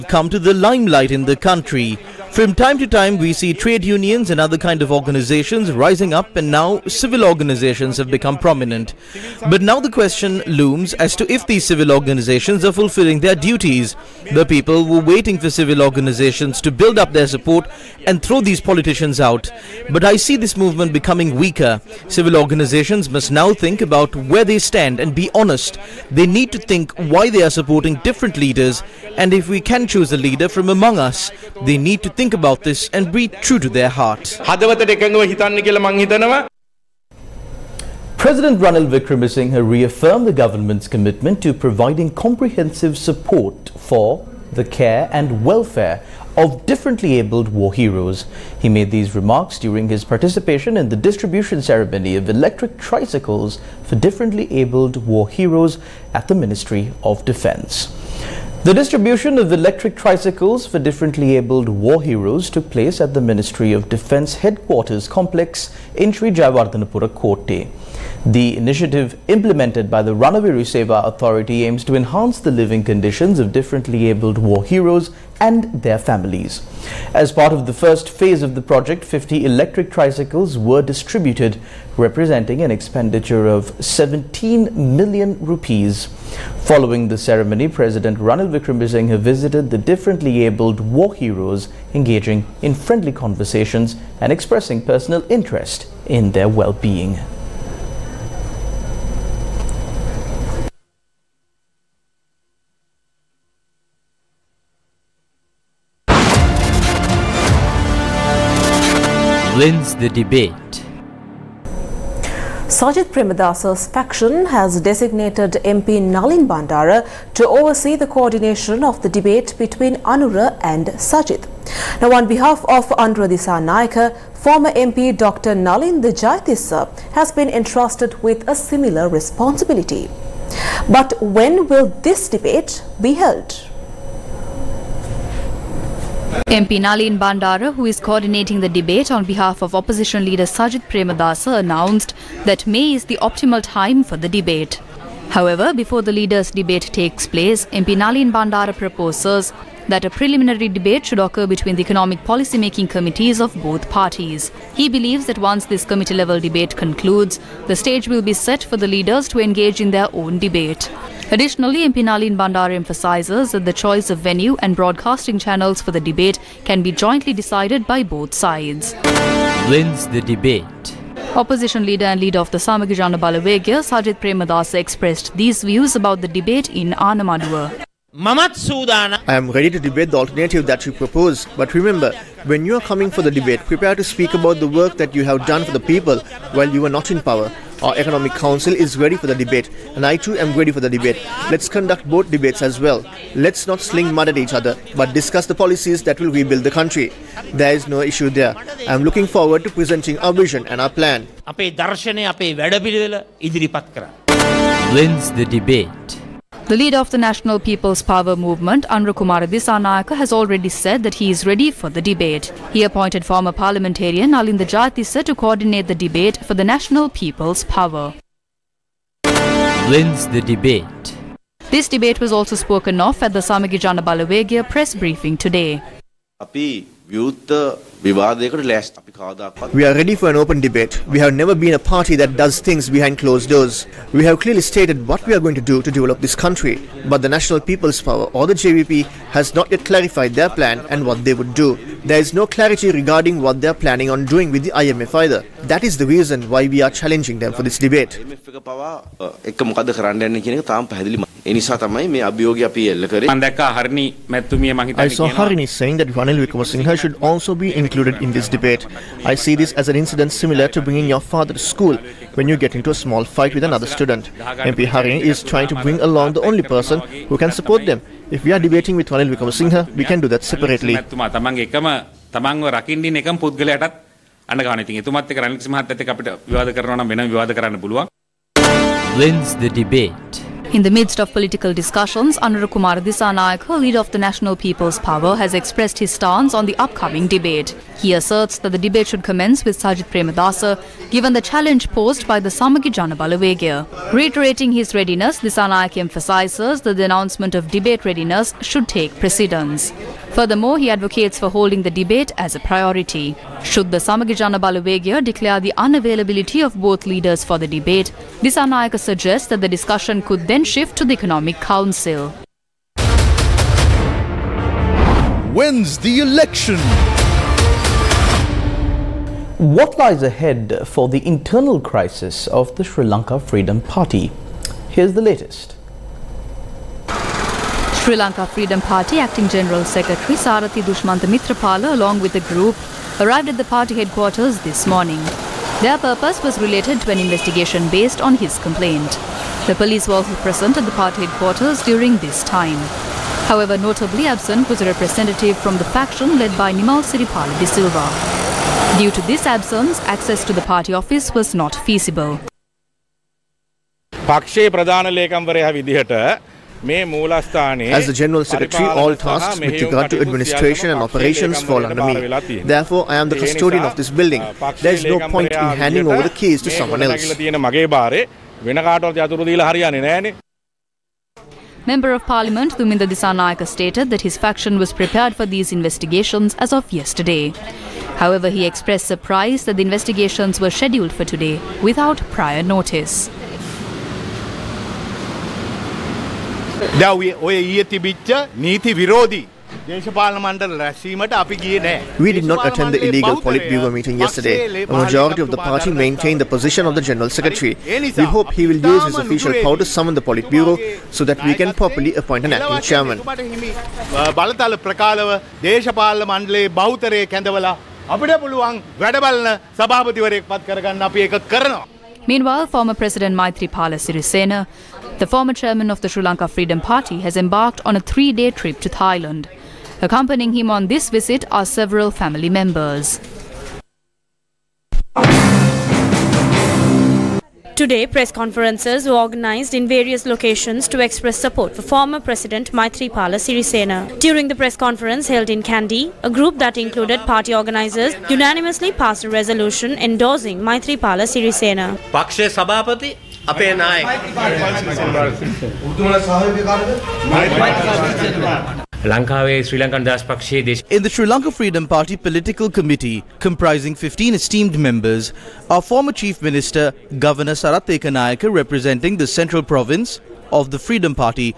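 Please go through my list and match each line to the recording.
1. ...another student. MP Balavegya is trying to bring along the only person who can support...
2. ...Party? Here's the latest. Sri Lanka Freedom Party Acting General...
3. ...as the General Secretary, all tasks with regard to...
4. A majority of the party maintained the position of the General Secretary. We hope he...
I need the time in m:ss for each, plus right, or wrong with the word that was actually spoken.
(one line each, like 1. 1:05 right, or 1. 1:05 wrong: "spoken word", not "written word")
1. 4:23 wrong: "Harini", not "Balavegya"
2. 5:23 right
3. 5:56 right
4. 6:34 right.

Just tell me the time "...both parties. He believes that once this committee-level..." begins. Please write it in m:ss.
2:33.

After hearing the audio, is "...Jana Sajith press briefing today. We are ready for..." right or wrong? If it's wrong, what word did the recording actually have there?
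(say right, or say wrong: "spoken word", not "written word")
wrong: "Balawegaya", not "Sajith".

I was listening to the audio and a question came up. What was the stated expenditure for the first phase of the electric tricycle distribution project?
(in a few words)
17 million rupees.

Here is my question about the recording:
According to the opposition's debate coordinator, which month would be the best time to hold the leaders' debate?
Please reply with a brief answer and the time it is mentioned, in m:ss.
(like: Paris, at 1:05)
May, at 2:22.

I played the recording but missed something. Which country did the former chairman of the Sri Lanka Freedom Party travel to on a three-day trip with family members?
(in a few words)
Thailand.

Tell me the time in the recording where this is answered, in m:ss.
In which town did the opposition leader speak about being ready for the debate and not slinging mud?
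2:56.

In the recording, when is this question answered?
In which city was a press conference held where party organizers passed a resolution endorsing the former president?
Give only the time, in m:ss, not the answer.
7:15.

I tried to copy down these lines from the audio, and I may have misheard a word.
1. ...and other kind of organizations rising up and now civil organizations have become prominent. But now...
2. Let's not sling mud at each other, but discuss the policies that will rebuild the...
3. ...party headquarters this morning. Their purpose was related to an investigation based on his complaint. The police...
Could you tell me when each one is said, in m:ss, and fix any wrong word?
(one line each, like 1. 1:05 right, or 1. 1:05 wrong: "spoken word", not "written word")
1. 0:04 right
2. 3:13 right
3. 5:33 right.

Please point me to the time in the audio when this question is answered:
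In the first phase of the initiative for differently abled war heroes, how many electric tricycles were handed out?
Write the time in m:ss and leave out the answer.
1:19.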